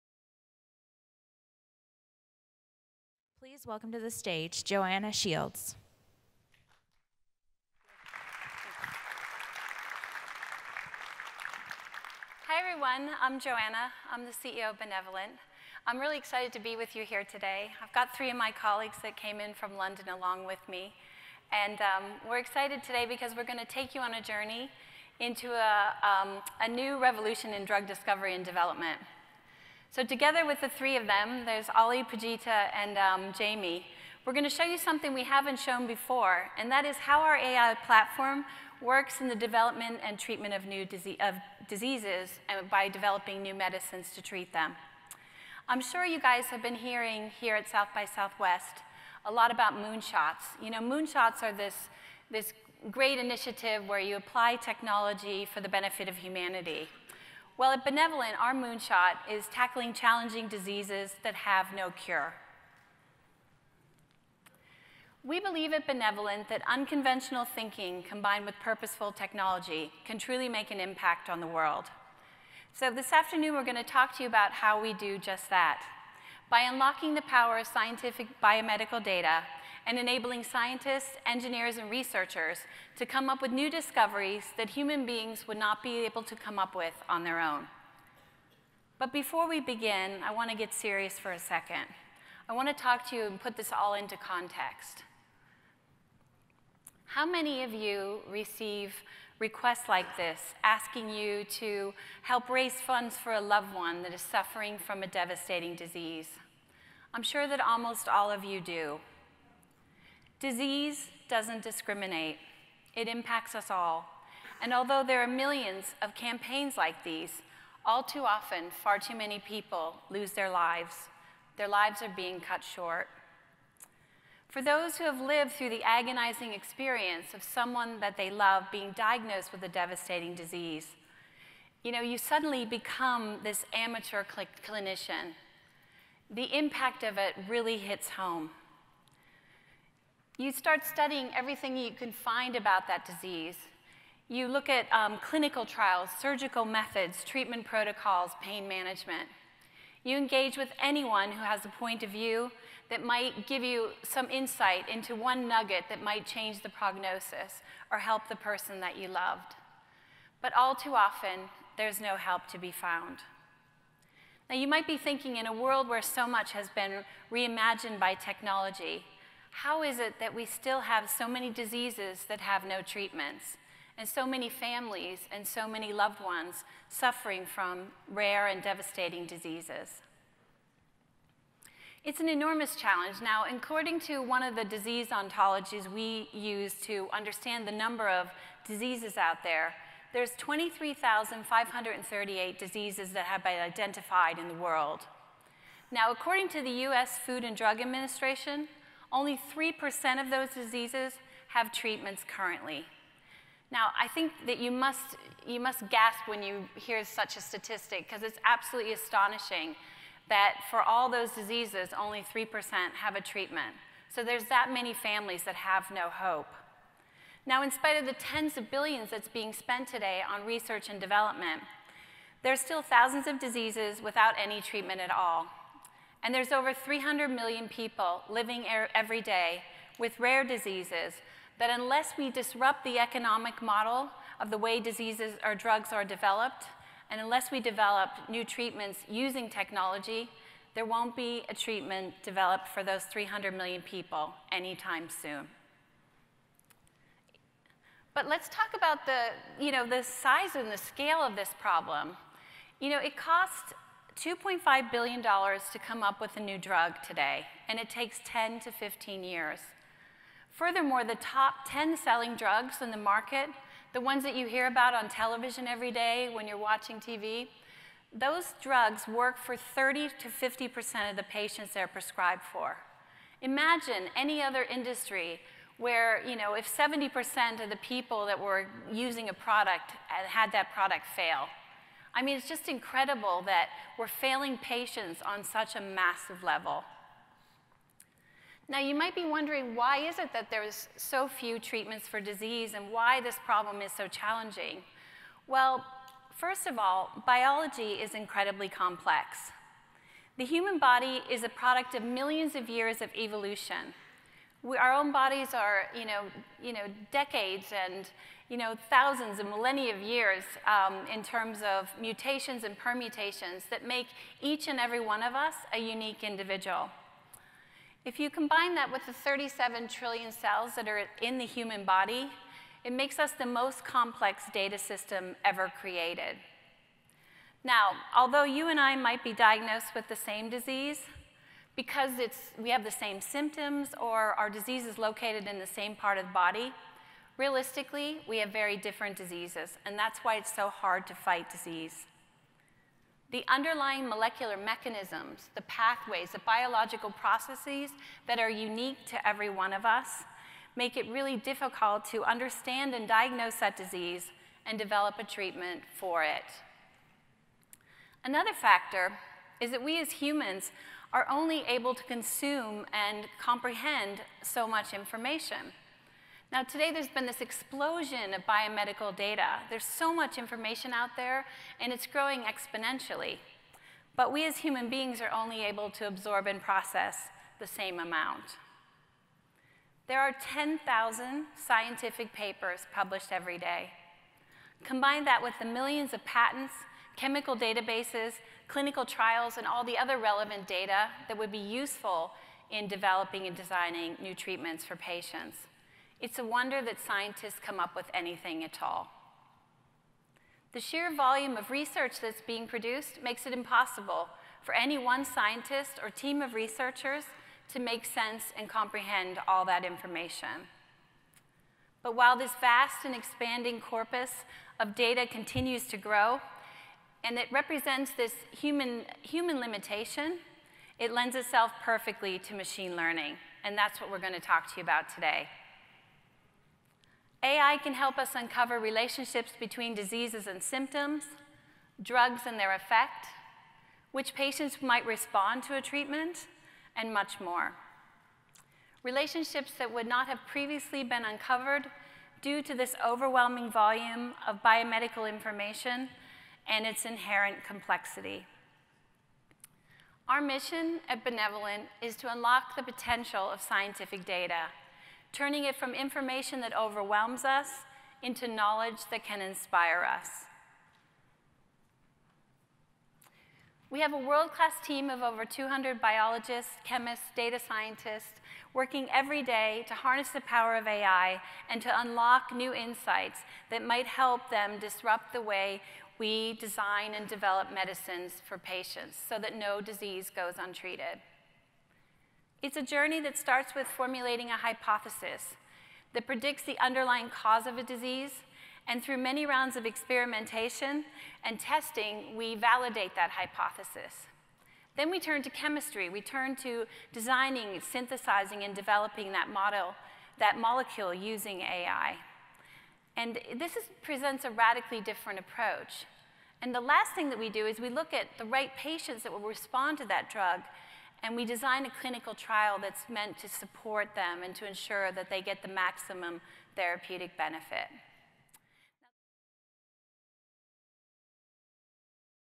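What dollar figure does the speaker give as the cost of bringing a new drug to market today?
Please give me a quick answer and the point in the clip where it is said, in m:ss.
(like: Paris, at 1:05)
$2.5 billion, at 4:14.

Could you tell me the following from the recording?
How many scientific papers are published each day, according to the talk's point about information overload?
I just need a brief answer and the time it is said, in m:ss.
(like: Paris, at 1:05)
10,000, at 6:20.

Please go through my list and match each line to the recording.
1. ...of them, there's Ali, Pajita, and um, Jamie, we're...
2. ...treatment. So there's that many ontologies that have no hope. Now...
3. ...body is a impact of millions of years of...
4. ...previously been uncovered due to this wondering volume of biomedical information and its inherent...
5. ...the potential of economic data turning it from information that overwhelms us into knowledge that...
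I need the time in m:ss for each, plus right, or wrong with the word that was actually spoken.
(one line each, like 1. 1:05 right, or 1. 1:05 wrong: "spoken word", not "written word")
1. 0:30 right
2. 3:33 wrong: "families", not "ontologies"
3. 5:00 wrong: "product", not "impact"
4. 7:20 wrong: "overwhelming", not "wondering"
5. 7:32 wrong: "scientific", not "economic".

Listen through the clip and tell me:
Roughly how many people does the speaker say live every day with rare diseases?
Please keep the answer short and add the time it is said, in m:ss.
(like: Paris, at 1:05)
over 300 million, at 3:46.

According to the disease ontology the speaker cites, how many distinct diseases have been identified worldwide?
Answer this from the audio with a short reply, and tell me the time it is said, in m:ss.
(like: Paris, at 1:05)
23,538, at 3:10.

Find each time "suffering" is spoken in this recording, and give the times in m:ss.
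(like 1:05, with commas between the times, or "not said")
1:44, 2:56.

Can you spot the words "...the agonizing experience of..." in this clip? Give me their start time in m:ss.
2:05.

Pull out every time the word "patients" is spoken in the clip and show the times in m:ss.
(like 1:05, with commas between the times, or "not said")
4:31, 4:44, 6:34, 7:14, 7:58, 8:28.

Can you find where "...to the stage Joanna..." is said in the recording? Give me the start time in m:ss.
0:03.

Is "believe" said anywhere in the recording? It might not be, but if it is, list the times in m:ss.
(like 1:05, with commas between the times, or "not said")
1:05.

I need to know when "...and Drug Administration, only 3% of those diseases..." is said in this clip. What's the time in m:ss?
3:17.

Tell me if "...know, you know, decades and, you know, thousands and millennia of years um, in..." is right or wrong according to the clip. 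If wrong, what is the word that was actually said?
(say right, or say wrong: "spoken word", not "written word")
right.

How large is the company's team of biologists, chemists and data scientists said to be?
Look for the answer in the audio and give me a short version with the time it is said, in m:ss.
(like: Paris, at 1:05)
over 200, at 7:45.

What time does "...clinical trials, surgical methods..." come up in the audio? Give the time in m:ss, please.
2:25.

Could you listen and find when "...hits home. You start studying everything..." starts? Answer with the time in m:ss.
2:17.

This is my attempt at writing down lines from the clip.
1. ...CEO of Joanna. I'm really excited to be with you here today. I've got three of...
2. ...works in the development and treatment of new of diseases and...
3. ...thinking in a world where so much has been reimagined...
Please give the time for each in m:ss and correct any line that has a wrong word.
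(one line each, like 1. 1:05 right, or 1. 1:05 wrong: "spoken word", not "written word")
1. 0:14 wrong: "Benevolent", not "Joanna"
2. 0:38 right
3. 2:44 right.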